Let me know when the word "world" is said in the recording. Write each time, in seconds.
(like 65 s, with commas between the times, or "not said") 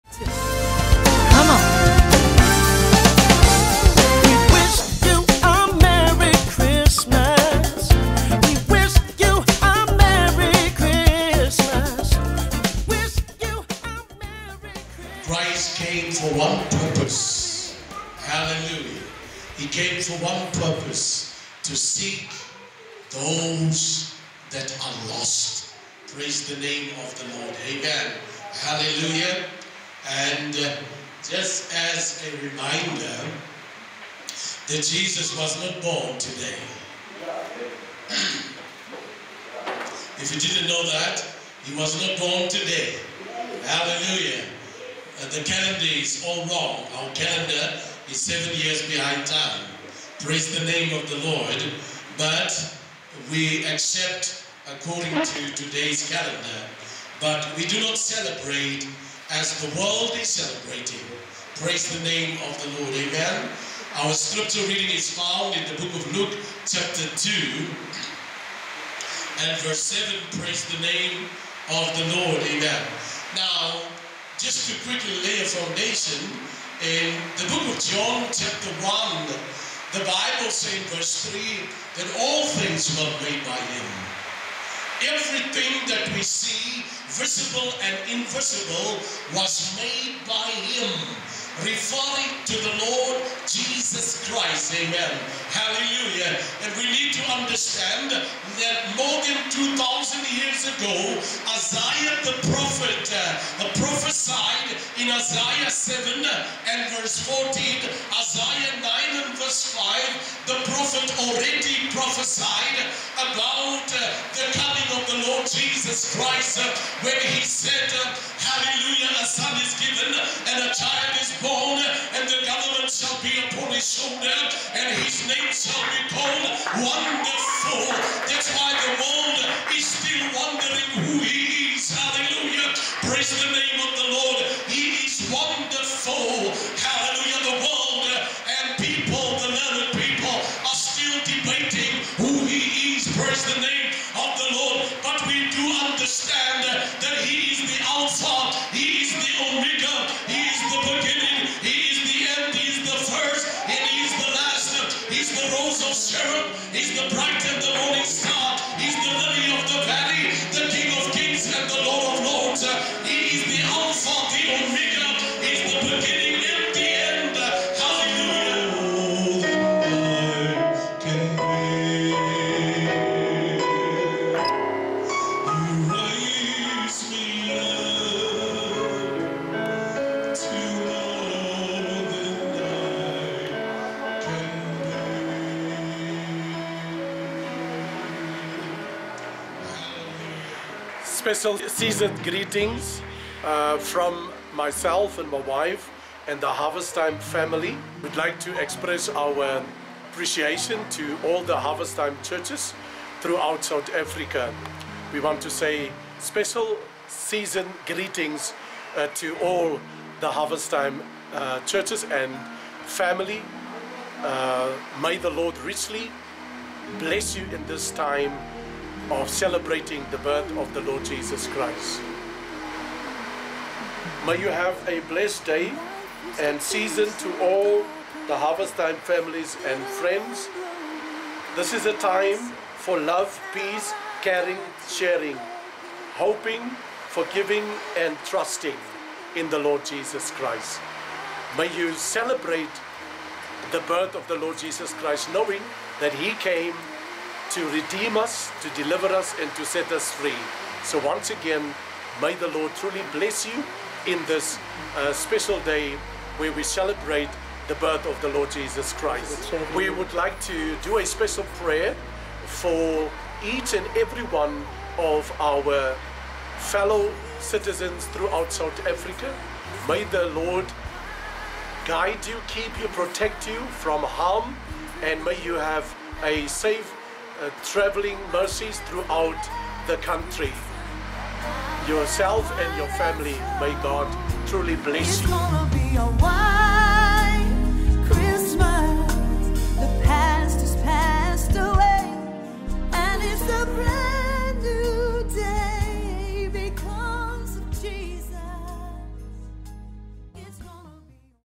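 59 s, 129 s, 137 s.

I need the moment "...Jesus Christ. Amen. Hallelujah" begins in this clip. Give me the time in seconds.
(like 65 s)
93 s.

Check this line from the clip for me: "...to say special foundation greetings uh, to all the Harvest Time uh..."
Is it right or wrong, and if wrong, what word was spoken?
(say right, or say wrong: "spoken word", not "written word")
wrong: "season", not "foundation".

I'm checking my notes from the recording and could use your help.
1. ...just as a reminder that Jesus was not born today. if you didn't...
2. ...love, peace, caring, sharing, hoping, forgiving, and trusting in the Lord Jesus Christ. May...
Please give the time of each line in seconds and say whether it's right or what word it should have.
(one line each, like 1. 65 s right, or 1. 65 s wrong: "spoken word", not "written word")
1. 31 s right
2. 232 s right.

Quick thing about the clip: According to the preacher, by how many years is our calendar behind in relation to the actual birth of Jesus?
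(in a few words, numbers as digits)
7.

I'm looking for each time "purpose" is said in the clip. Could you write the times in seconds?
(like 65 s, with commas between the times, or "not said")
20 s.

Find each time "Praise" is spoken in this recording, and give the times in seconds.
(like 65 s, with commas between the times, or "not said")
26 s, 50 s, 61 s, 70 s, 133 s, 143 s.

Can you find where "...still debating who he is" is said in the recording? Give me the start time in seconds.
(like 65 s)
140 s.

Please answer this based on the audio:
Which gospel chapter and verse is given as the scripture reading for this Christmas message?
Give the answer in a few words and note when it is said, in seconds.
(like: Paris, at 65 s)
Luke 2:7, at 66 s.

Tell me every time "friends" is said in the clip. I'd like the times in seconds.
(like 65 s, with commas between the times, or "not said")
229 s.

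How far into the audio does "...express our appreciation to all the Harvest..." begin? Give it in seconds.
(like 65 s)
198 s.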